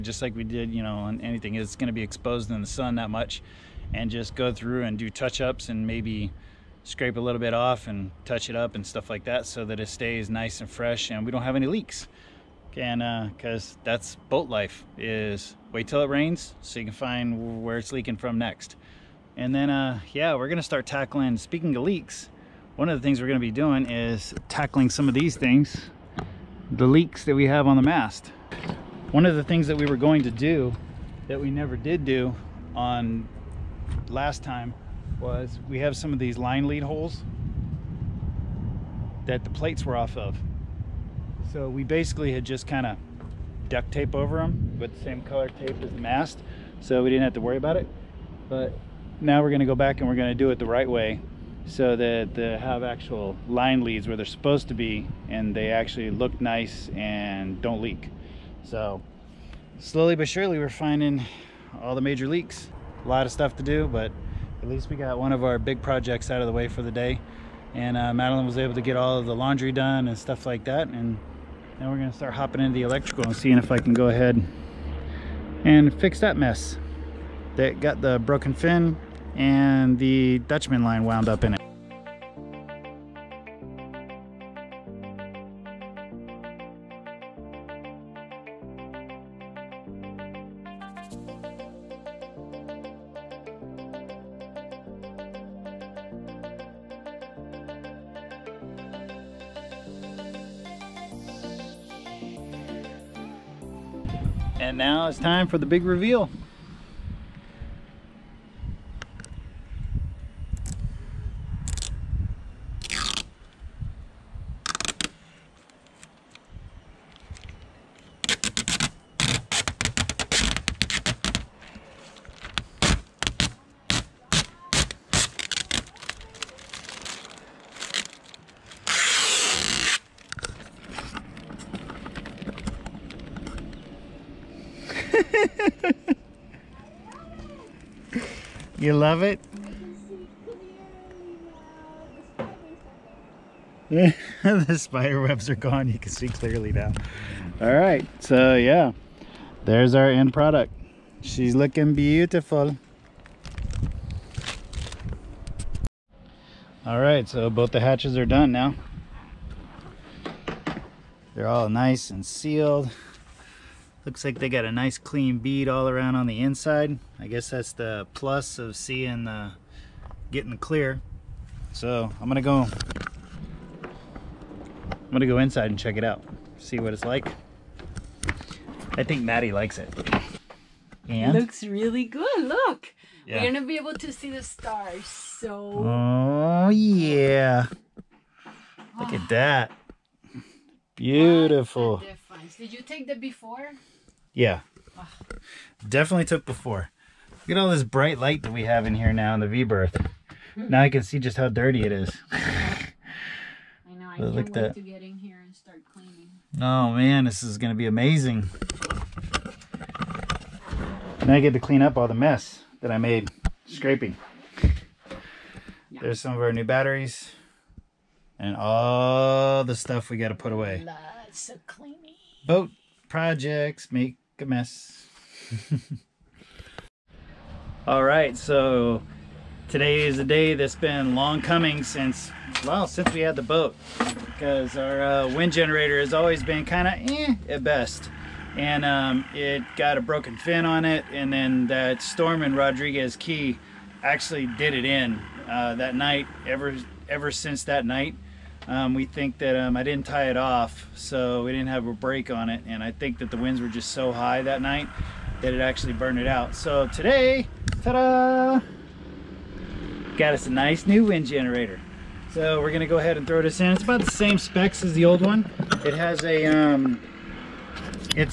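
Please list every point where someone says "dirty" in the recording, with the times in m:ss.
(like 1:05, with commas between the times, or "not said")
3:21.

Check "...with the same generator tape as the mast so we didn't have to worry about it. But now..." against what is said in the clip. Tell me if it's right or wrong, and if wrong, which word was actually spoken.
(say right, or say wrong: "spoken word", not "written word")
wrong: "color", not "generator".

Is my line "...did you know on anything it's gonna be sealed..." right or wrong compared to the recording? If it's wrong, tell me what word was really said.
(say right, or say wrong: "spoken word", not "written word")
wrong: "exposed", not "sealed".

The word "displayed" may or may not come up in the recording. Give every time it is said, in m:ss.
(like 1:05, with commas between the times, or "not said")
not said.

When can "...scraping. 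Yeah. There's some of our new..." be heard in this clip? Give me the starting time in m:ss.
3:33.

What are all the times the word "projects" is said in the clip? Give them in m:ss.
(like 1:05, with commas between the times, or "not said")
1:05, 3:43.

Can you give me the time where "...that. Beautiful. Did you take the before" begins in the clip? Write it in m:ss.
3:09.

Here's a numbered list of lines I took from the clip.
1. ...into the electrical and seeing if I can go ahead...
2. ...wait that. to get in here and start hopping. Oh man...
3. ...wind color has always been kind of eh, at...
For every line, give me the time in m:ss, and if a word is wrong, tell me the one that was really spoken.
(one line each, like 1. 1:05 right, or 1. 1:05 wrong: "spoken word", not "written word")
1. 1:12 right
2. 3:24 wrong: "cleaning", not "hopping"
3. 3:55 wrong: "generator", not "color".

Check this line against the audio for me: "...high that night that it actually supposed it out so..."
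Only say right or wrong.
wrong.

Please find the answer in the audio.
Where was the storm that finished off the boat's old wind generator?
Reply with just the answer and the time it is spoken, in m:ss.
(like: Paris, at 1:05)
Rodriguez Key, at 4:02.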